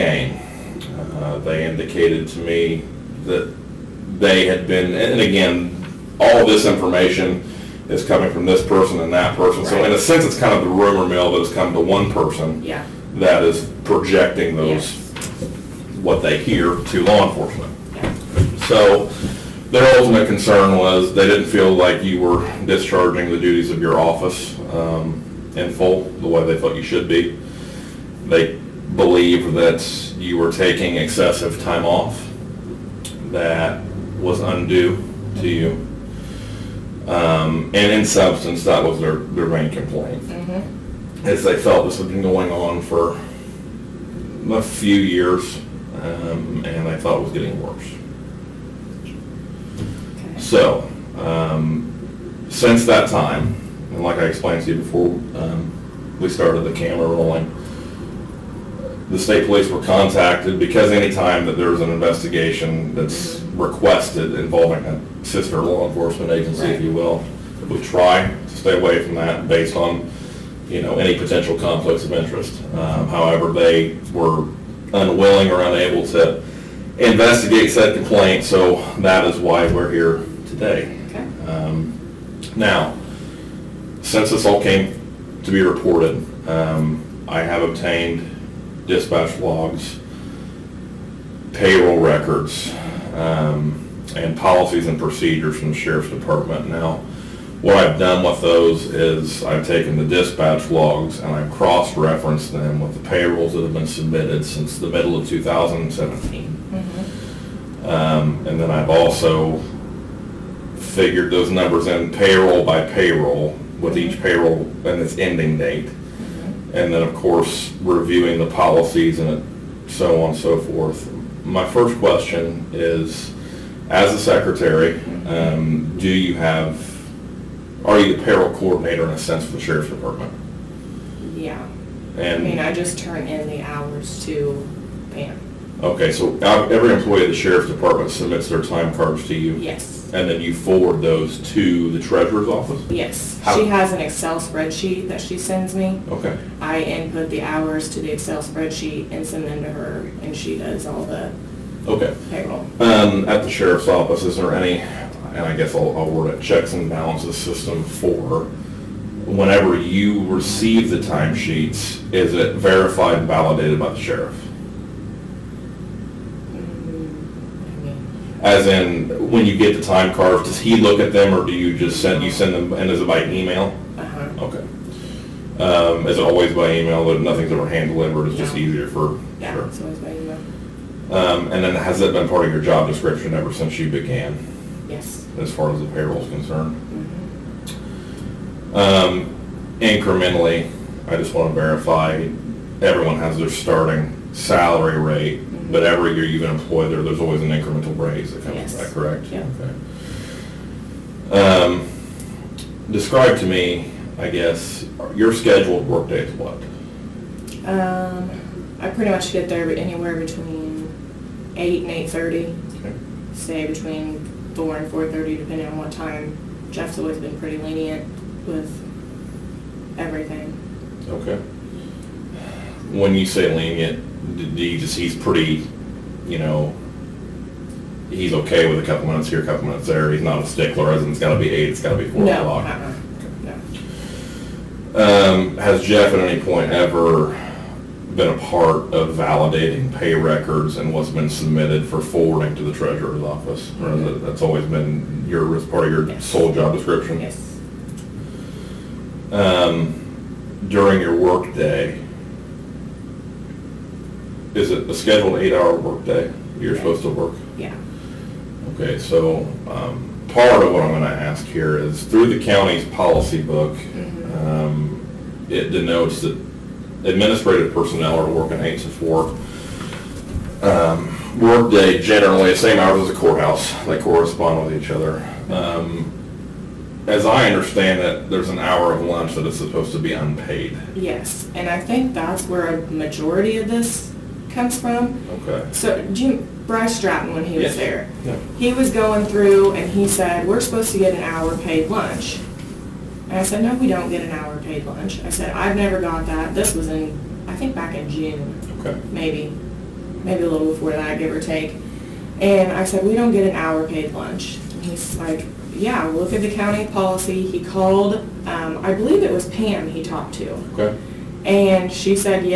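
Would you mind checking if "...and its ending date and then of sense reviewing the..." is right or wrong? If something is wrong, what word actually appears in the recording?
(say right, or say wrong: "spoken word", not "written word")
wrong: "course", not "sense".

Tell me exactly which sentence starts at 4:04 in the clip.
that's always been your part of your yes.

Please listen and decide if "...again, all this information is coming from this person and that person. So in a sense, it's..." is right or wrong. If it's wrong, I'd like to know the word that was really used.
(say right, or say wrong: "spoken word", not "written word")
right.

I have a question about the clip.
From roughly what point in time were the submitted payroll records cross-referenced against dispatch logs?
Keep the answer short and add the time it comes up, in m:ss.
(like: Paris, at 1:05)
Middle of 2017, at 1:44.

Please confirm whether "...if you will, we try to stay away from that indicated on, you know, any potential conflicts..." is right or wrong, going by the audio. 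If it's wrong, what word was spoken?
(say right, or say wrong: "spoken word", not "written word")
wrong: "based", not "indicated".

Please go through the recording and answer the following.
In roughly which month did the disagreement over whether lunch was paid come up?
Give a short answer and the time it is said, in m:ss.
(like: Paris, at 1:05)
June, at 4:58.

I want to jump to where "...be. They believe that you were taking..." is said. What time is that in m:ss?
0:27.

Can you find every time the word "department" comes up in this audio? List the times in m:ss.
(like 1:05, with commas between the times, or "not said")
1:36, 2:09, 2:17.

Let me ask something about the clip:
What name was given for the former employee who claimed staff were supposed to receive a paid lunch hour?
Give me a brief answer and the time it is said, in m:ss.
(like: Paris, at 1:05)
Bryce Stratton, at 4:46.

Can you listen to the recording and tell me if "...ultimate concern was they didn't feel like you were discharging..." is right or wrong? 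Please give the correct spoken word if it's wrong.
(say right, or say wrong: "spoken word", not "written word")
right.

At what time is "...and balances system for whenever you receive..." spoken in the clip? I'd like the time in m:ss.
2:36.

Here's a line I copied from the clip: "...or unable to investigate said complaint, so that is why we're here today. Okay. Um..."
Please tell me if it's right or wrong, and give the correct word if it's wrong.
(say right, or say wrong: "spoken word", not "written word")
right.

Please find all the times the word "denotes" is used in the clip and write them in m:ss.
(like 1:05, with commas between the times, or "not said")
4:25.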